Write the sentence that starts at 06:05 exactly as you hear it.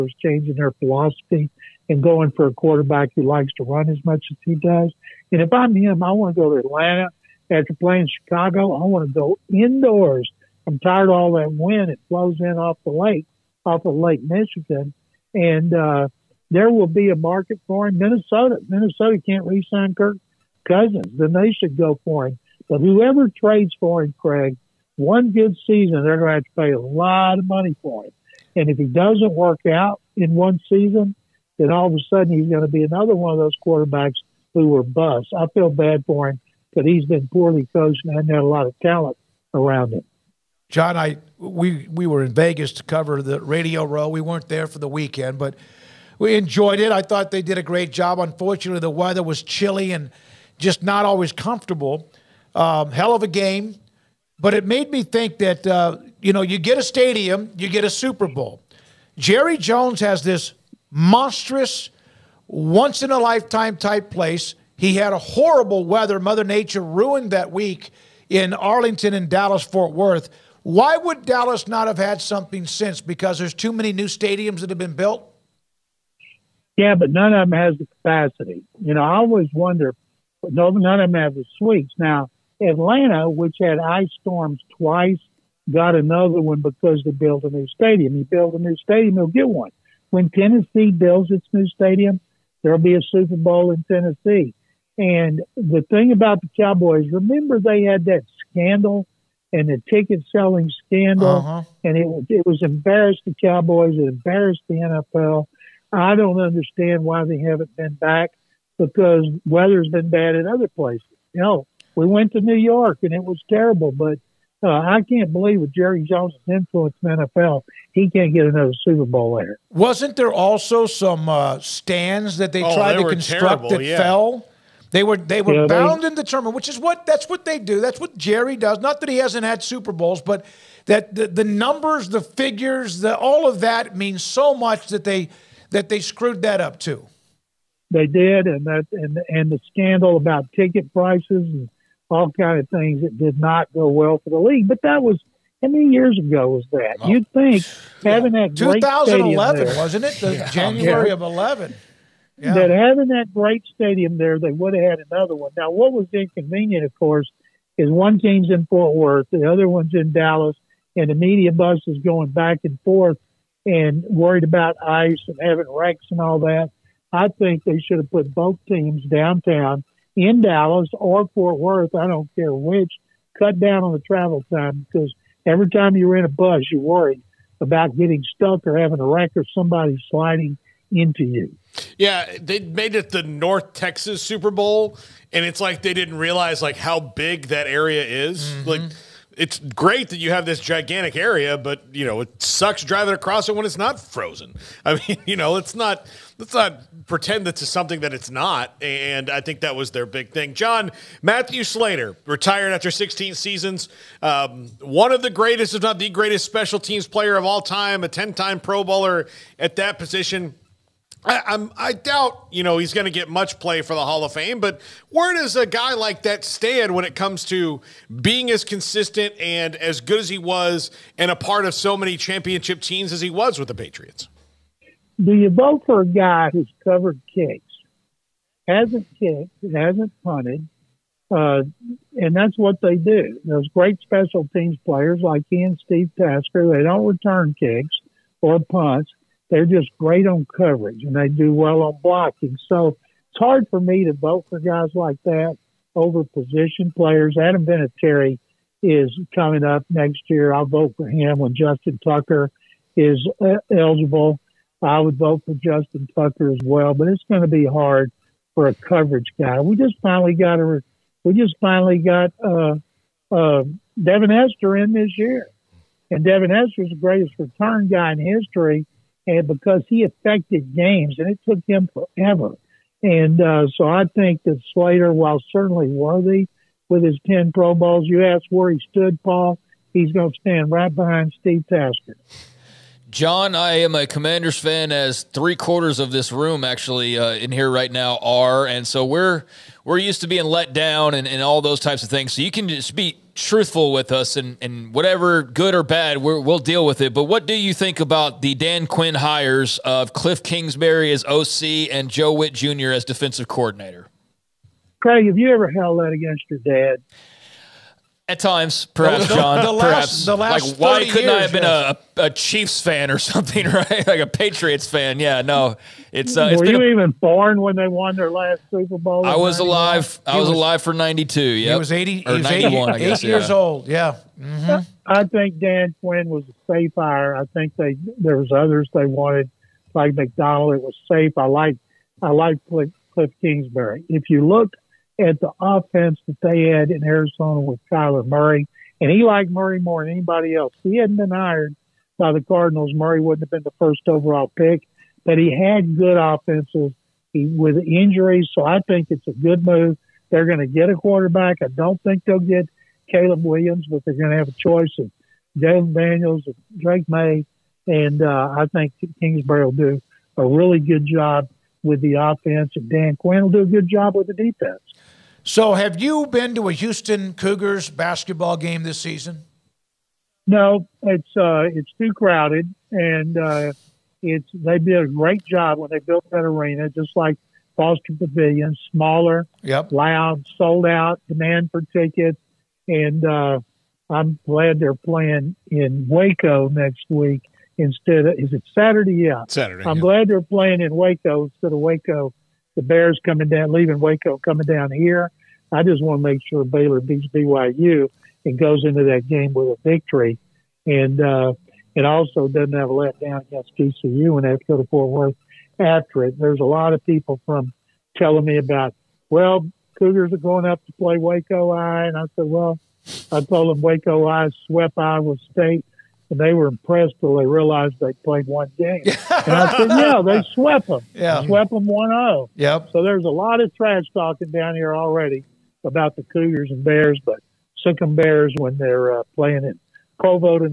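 So, have you been to a Houston Cougars basketball game this season?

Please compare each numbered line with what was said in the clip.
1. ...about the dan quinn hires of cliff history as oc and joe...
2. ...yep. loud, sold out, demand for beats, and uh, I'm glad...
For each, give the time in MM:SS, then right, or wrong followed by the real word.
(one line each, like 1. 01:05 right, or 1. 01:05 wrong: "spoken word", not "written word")
1. 04:57 wrong: "kingsbury", not "history"
2. 06:19 wrong: "tickets", not "beats".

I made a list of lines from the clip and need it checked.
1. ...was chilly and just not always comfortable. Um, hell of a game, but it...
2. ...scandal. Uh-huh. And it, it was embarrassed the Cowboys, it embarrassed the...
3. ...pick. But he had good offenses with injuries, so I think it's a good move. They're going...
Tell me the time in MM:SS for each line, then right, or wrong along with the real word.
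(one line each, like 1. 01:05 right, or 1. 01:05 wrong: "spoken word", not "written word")
1. 00:49 right
2. 01:40 right
3. 05:44 right.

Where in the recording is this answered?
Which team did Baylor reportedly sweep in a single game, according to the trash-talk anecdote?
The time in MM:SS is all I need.
06:54.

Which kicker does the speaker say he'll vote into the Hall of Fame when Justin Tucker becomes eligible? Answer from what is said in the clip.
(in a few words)
Adam Vinatieri.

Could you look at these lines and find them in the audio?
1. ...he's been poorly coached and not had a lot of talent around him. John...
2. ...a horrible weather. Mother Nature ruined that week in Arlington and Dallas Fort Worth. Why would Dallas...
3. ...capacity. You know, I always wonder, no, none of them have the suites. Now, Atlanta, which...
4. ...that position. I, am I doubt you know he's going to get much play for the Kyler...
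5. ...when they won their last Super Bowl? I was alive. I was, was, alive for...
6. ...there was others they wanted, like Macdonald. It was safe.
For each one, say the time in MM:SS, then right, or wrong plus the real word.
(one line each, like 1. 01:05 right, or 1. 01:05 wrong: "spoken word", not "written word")
1. 00:36 right
2. 01:05 right
3. 01:17 right
4. 03:29 wrong: "Hall", not "Kyler"
5. 05:17 right
6. 05:28 right.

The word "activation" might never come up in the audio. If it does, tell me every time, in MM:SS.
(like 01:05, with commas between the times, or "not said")
not said.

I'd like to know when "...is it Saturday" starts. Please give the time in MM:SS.
06:28.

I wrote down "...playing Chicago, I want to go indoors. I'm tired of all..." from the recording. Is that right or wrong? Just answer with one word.
right.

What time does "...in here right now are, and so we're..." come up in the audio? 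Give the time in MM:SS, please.
04:47.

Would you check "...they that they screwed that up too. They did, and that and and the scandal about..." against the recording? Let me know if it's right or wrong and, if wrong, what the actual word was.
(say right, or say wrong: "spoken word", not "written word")
right.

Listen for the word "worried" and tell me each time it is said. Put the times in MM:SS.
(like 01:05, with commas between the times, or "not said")
02:44, 02:56.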